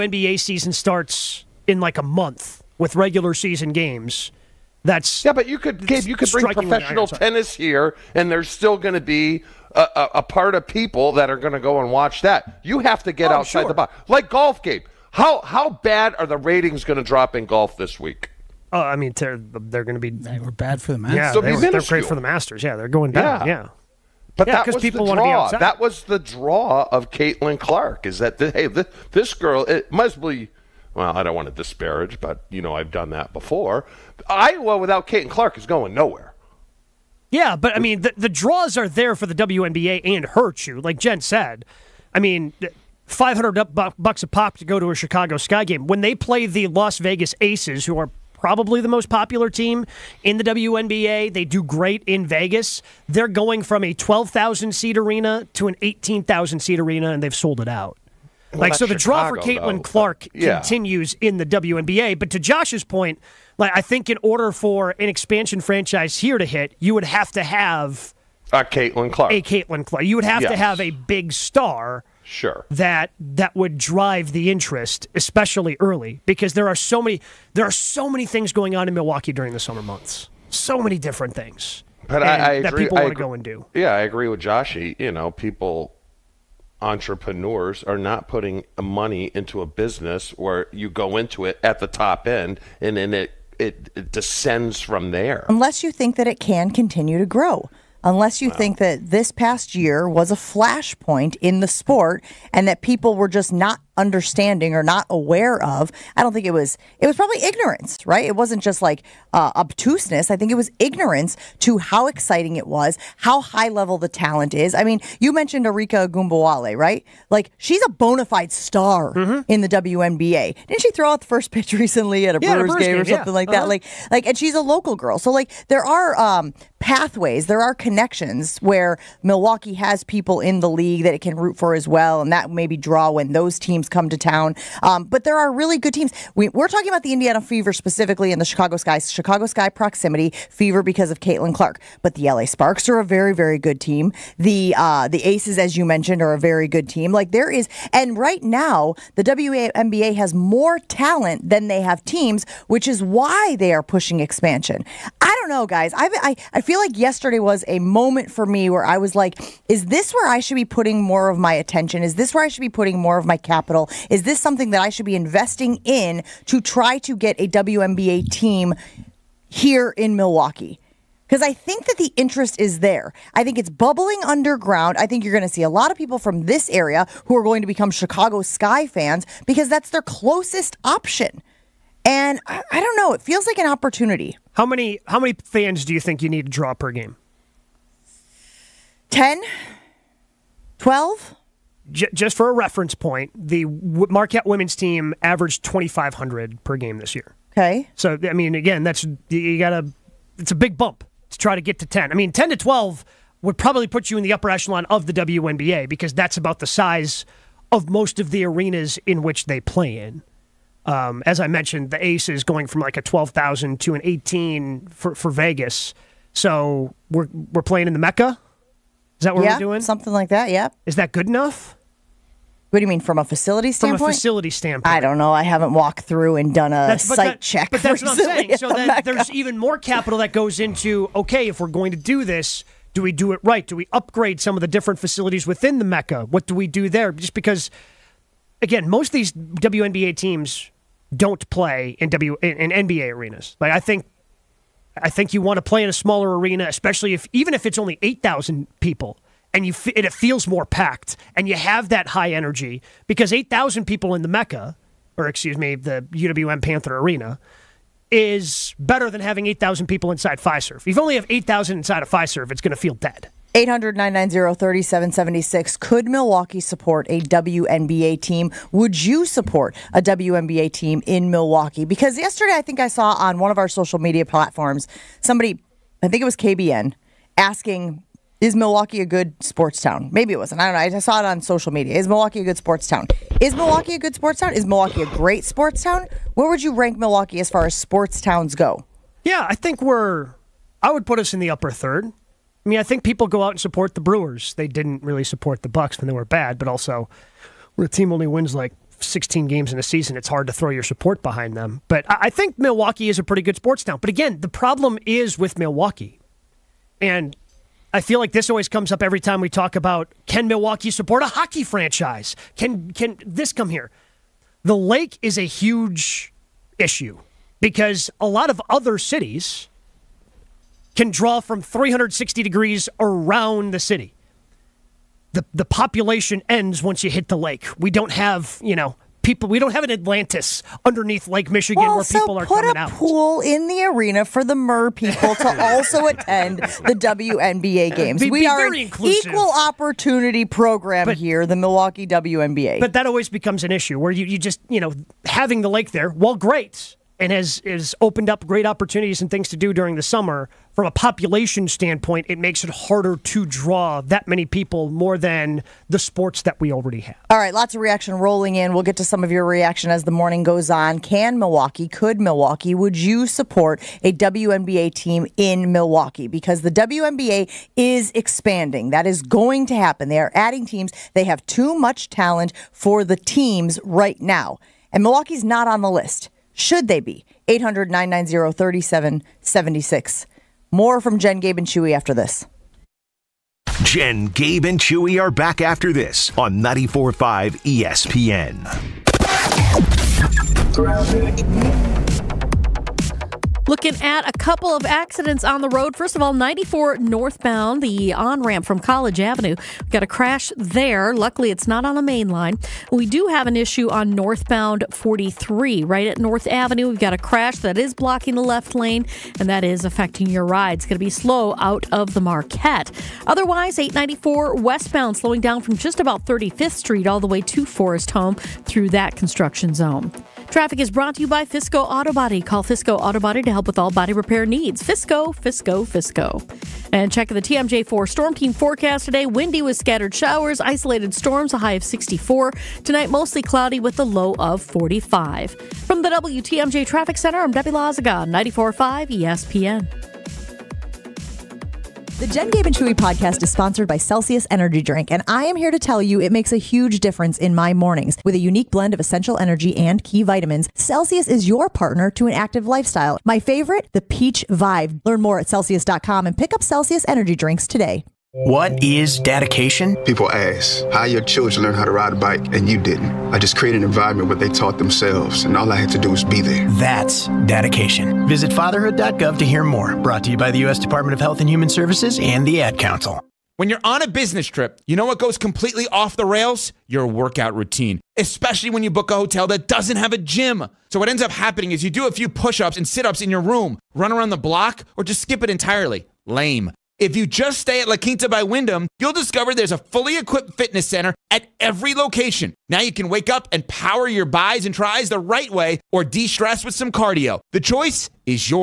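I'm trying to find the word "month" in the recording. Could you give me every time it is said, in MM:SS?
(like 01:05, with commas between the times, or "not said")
00:02, 01:19.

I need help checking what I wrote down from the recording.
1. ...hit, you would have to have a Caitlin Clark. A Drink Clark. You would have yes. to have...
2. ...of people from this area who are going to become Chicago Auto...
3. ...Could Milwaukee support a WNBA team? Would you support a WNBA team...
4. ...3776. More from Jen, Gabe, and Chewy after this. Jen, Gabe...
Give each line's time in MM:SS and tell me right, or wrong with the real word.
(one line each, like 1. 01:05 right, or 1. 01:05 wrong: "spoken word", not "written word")
1. 01:06 wrong: "Caitlin", not "Drink"
2. 02:55 wrong: "Sky", not "Auto"
3. 04:25 right
4. 06:18 right.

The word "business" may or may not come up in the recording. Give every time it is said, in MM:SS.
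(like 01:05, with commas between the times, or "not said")
01:29, 07:54.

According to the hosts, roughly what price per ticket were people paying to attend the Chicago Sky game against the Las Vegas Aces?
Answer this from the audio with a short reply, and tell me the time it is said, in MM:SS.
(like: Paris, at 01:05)
$500, at 00:43.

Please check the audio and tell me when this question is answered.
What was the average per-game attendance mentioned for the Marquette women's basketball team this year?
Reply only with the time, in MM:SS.
03:15.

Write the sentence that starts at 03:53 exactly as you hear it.
Do we upgrade some of the different facilities within the Mecca?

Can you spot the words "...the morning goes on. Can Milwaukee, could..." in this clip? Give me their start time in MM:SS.
06:00.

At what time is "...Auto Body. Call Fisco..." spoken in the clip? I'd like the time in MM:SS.
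07:01.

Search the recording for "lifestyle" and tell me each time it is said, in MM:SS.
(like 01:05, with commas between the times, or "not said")
07:32.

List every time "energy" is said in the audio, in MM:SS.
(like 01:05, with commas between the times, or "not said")
04:12, 07:24, 07:29, 07:37.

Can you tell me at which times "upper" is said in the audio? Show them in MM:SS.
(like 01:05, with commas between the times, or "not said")
03:24, 04:51.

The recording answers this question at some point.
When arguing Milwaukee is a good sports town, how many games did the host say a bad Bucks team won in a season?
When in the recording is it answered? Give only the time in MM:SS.
04:59.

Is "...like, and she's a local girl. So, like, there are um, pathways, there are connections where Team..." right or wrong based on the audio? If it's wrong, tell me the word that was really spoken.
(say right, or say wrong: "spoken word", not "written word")
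wrong: "Milwaukee", not "Team".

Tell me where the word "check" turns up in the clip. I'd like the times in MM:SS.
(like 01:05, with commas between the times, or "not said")
03:47, 07:07.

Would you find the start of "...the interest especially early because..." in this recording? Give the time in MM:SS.
01:14.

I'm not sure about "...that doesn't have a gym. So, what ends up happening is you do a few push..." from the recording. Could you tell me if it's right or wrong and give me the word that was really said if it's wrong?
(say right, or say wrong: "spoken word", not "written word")
right.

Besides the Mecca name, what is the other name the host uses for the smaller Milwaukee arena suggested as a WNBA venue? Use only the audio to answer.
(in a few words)
UWM Panther Arena.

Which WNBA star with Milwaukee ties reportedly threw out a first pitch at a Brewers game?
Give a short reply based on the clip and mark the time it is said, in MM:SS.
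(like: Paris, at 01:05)
Arike Ogunbowale, at 01:55.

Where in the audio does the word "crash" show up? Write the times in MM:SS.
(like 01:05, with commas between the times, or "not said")
06:40, 06:47.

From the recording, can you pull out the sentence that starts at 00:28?
Is that the, hey, this, this girl?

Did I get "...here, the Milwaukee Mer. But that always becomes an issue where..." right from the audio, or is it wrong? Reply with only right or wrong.
wrong.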